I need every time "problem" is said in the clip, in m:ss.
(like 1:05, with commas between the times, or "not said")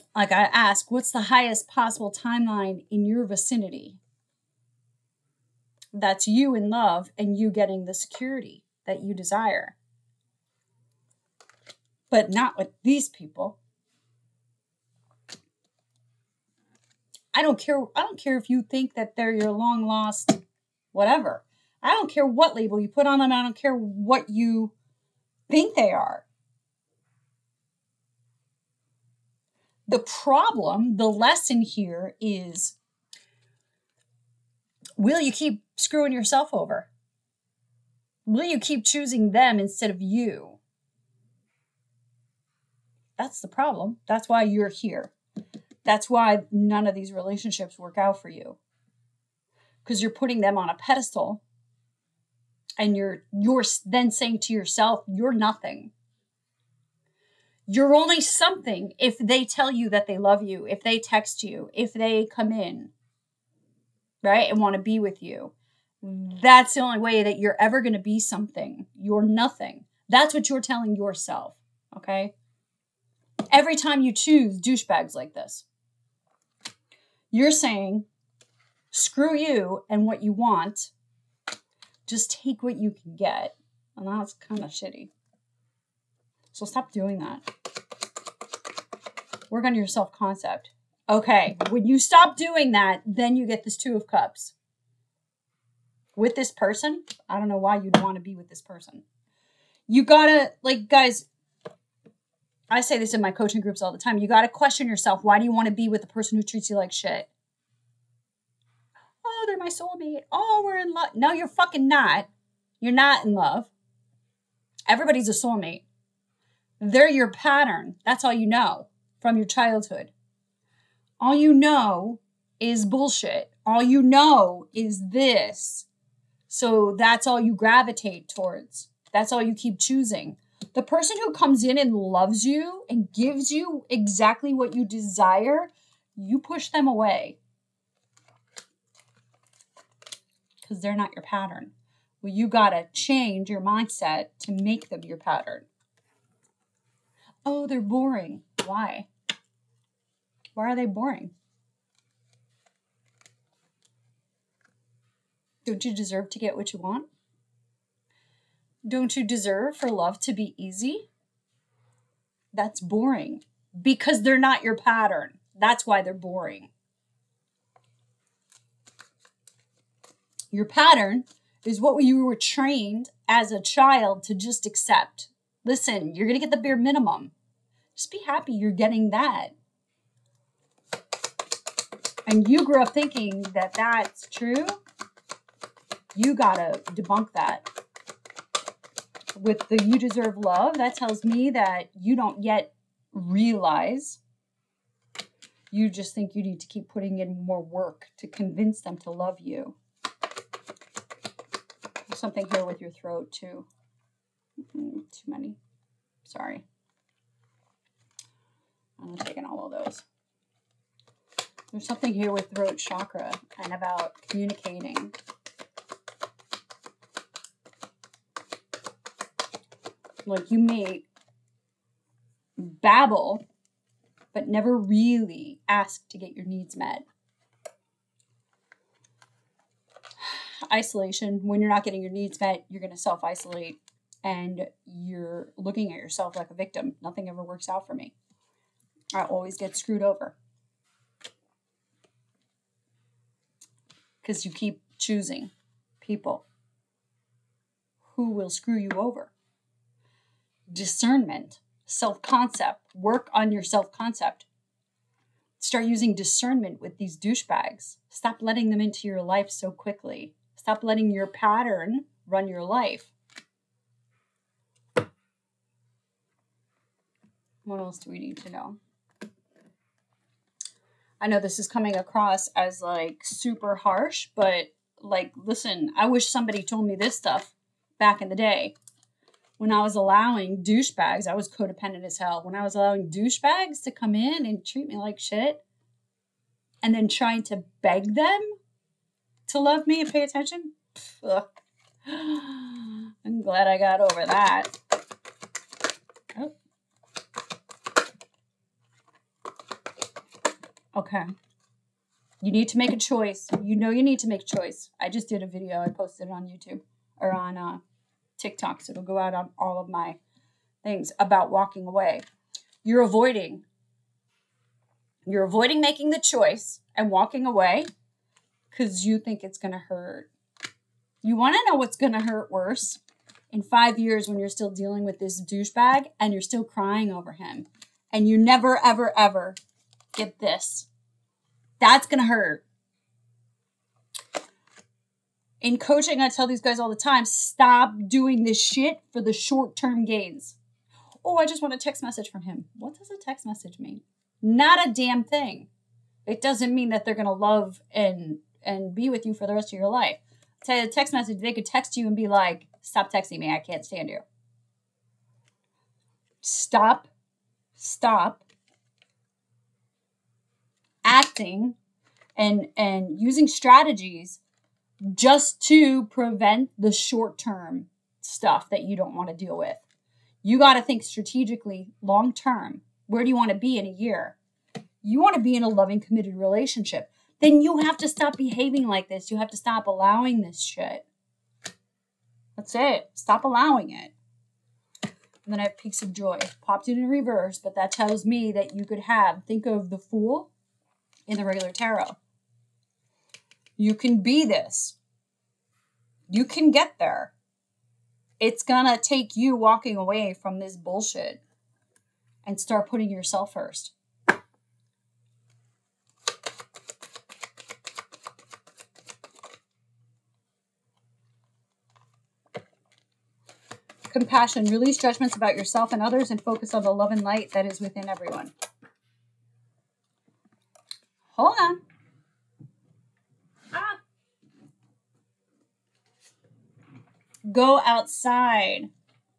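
0:29, 0:43.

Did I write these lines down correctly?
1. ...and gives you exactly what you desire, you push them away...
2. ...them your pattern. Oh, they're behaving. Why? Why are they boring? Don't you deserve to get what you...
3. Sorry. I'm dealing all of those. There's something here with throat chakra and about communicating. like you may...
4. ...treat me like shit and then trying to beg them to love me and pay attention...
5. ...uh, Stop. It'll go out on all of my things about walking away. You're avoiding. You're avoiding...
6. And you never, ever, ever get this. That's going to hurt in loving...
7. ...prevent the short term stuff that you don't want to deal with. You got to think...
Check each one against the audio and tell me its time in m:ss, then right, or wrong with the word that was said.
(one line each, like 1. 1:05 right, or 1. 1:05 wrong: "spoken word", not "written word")
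1. 2:12 right
2. 2:24 wrong: "boring", not "behaving"
3. 3:26 wrong: "taking", not "dealing"
4. 4:44 right
5. 5:07 wrong: "TikToks", not "Stop"
6. 5:28 wrong: "coaching", not "loving"
7. 6:06 right.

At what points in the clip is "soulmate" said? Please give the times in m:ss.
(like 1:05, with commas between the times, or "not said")
1:49, 1:55.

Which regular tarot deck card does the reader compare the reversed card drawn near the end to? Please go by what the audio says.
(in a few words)
The Fool.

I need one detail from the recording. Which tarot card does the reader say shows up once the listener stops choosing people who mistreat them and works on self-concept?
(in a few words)
Two of Cups.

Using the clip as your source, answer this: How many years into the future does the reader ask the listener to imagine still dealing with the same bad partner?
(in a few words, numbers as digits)
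5.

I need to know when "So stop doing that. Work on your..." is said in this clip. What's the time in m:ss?
1:26.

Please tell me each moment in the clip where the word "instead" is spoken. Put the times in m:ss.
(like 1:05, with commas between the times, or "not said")
0:39.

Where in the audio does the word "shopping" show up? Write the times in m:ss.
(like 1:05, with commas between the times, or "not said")
not said.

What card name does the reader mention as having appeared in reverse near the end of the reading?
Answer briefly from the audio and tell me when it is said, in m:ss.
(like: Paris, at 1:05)
Peaks of Joy, at 6:25.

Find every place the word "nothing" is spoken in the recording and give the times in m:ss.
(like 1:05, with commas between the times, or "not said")
0:55, 1:09, 3:57.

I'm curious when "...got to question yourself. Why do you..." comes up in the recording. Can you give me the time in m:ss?
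1:44.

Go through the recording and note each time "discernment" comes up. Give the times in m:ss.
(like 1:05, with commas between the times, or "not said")
4:10, 4:16.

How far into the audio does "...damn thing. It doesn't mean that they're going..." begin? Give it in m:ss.
5:44.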